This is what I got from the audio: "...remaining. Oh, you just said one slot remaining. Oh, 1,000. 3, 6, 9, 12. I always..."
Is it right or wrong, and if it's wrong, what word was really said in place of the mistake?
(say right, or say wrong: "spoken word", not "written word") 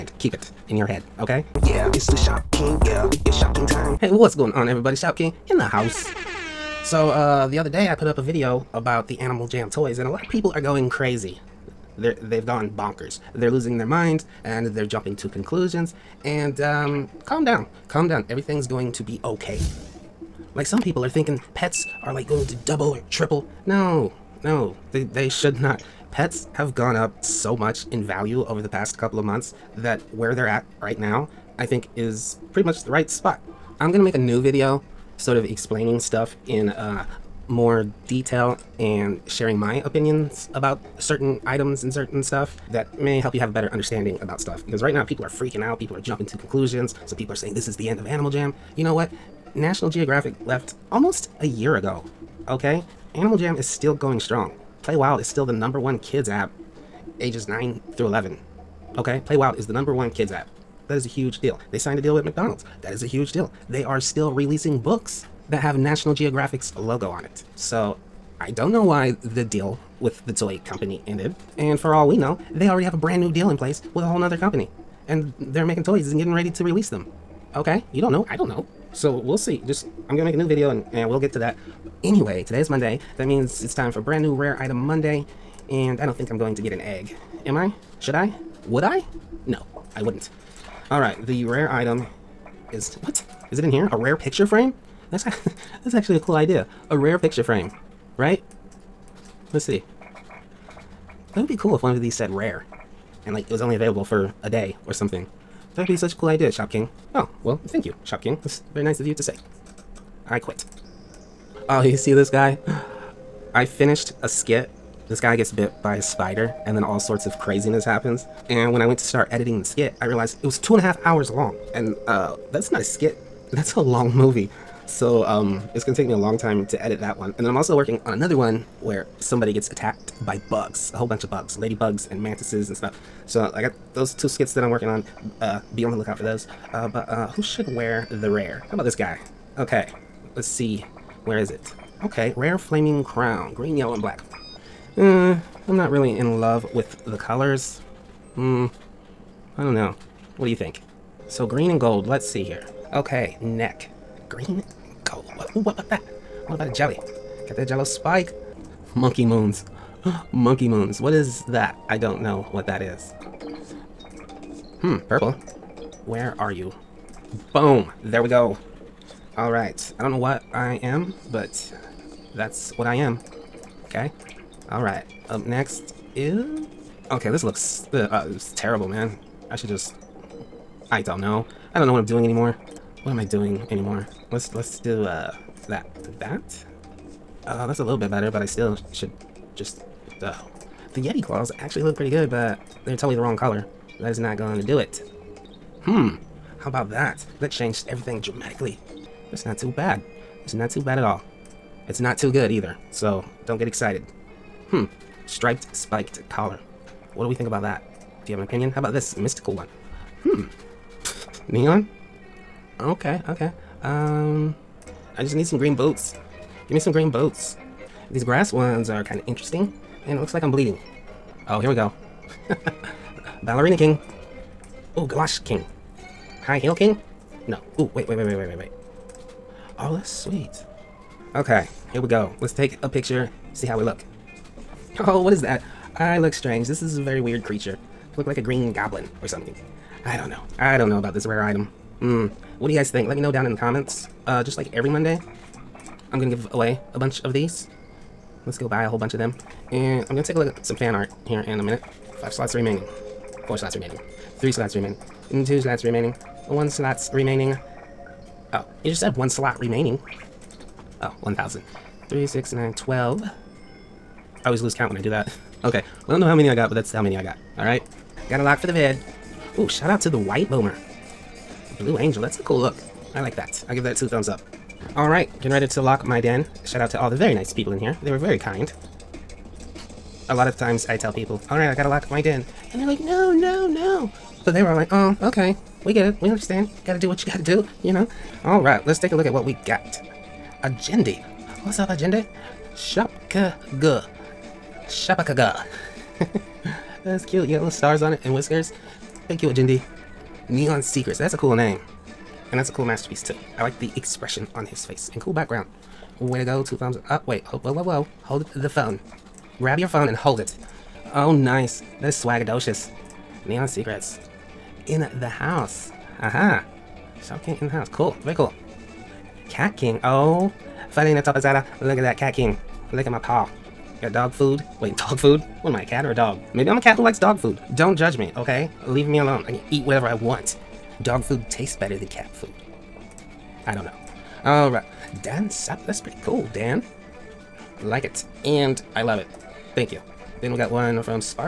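right.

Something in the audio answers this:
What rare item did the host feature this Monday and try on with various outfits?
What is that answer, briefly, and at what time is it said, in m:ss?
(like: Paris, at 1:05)
rare flaming crown, at 2:22.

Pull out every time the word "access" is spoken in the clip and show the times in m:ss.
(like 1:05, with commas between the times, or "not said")
not said.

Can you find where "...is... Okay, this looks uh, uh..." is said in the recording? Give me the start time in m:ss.
2:56.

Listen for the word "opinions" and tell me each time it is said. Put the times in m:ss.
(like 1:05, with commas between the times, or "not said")
0:39, 3:28.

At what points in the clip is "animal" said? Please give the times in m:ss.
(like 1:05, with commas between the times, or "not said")
0:09, 0:48, 0:53.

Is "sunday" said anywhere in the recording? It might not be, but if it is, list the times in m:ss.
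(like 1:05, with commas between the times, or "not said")
not said.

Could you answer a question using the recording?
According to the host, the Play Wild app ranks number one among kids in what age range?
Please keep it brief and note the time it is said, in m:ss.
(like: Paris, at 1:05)
9 through 11, at 0:57.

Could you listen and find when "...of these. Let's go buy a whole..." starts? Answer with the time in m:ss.
4:07.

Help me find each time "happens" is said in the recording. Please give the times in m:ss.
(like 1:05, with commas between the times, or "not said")
1:57.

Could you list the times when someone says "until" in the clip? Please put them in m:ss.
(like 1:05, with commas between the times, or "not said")
not said.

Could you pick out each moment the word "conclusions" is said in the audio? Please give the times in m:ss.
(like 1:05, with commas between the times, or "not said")
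0:15, 0:46.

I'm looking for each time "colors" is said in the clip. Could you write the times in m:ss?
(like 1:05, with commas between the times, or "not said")
2:27, 3:13.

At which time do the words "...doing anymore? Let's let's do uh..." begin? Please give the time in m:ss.
3:03.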